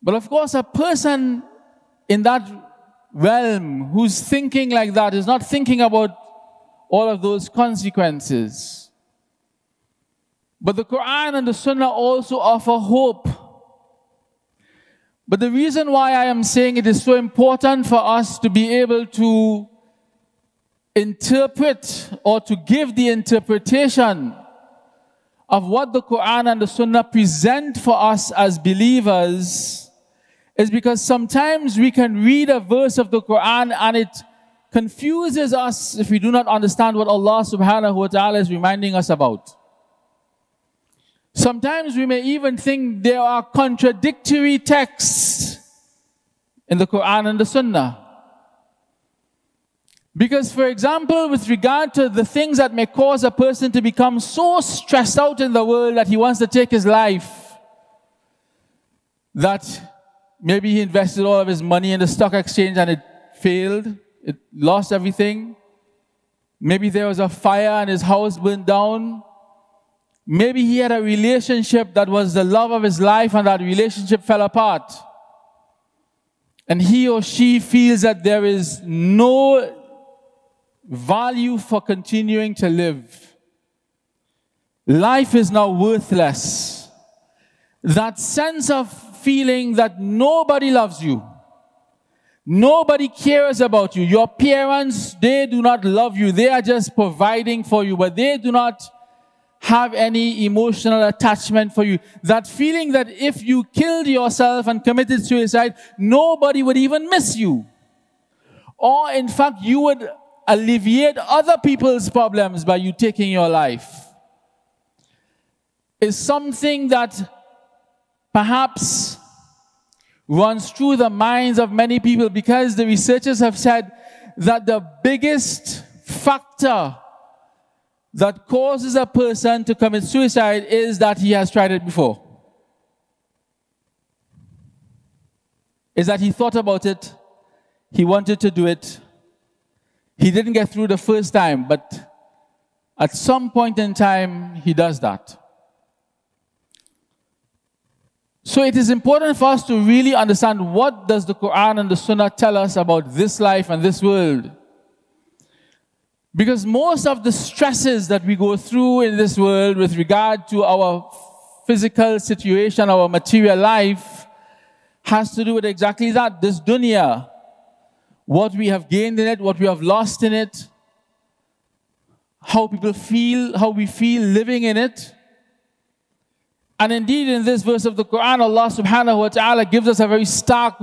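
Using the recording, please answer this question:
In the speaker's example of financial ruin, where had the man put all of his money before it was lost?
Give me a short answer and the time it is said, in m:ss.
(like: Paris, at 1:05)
The stock exchange, at 1:02.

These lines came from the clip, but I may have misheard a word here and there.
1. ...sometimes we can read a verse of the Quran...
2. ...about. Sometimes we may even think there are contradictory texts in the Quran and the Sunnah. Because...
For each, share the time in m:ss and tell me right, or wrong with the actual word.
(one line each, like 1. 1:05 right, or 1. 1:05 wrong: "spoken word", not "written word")
1. 0:31 right
2. 0:39 right.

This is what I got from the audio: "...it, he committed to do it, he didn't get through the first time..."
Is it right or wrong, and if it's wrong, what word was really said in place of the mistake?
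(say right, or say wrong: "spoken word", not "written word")
wrong: "wanted", not "committed".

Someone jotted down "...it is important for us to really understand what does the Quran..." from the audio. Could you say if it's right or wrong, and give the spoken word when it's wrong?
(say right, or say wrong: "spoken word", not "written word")
right.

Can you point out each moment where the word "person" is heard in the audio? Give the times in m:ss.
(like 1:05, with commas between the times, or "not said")
0:00, 0:53, 2:09.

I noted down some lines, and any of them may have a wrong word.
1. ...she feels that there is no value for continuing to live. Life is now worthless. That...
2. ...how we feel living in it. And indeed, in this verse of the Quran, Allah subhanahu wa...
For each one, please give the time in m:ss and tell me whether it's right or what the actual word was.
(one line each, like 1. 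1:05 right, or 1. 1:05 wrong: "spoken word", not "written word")
1. 1:17 right
2. 2:53 right.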